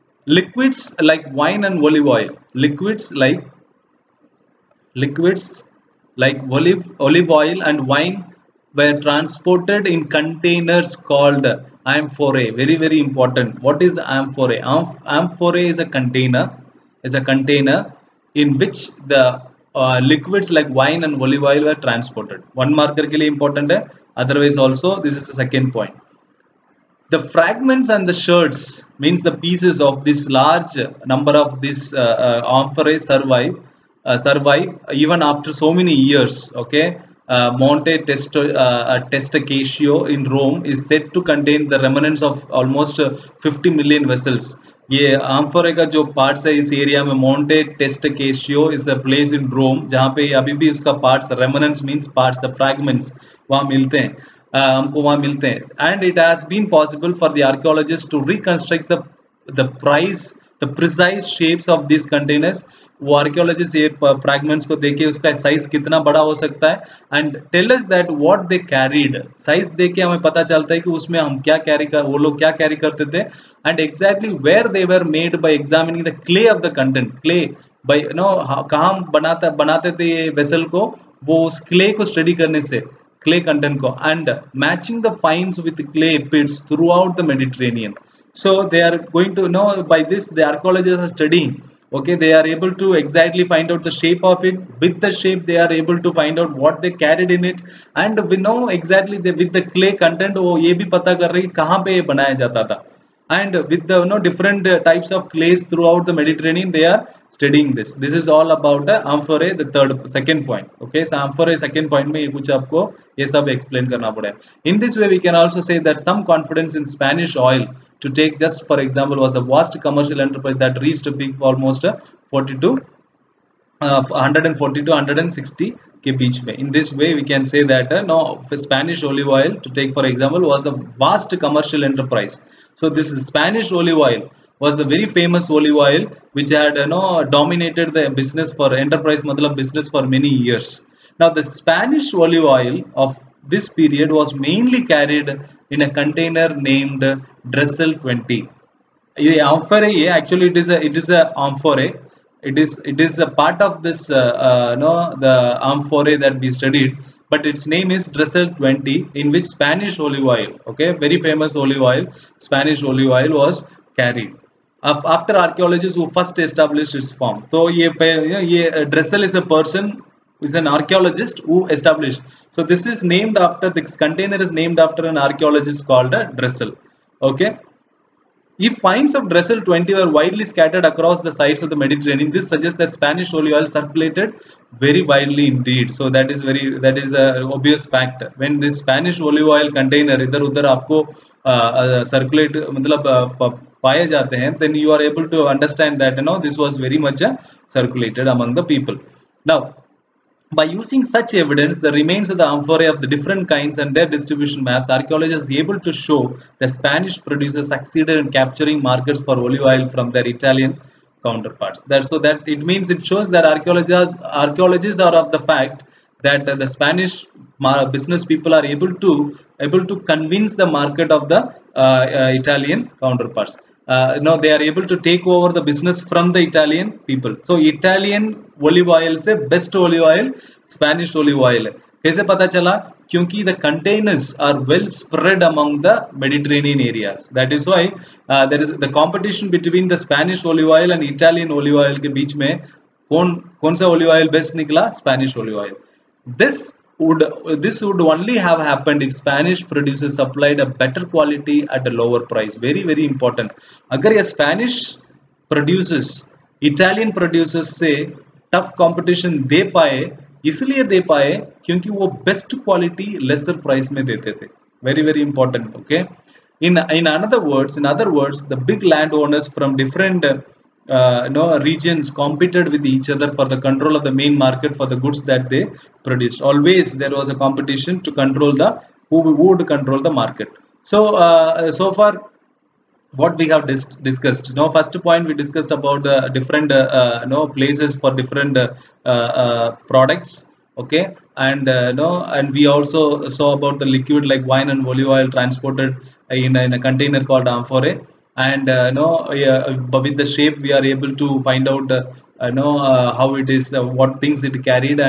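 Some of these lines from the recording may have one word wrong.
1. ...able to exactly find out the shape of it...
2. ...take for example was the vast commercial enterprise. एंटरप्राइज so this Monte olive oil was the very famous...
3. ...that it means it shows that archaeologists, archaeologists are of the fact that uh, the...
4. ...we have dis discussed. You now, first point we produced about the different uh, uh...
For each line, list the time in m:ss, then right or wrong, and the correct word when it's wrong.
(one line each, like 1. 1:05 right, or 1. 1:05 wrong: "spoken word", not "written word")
1. 1:32 right
2. 2:09 wrong: "Spanish", not "Monte"
3. 3:32 right
4. 4:43 wrong: "discussed", not "produced".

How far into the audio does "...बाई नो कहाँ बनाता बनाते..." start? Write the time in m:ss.
1:17.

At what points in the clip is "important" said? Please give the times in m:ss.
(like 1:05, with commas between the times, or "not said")
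0:13, 0:23, 4:13, 4:25.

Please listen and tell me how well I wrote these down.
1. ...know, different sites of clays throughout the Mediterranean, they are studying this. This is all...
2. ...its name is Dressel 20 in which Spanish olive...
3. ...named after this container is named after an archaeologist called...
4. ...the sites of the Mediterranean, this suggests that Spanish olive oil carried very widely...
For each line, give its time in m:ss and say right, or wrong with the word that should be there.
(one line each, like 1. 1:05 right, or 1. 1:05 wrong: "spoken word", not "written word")
1. 1:44 wrong: "types", not "sites"
2. 2:37 right
3. 2:53 right
4. 3:01 wrong: "circulated", not "carried".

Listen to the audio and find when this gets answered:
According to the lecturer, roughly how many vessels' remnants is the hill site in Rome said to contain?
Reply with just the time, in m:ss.
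0:43.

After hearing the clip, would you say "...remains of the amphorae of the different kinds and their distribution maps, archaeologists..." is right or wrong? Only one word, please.
right.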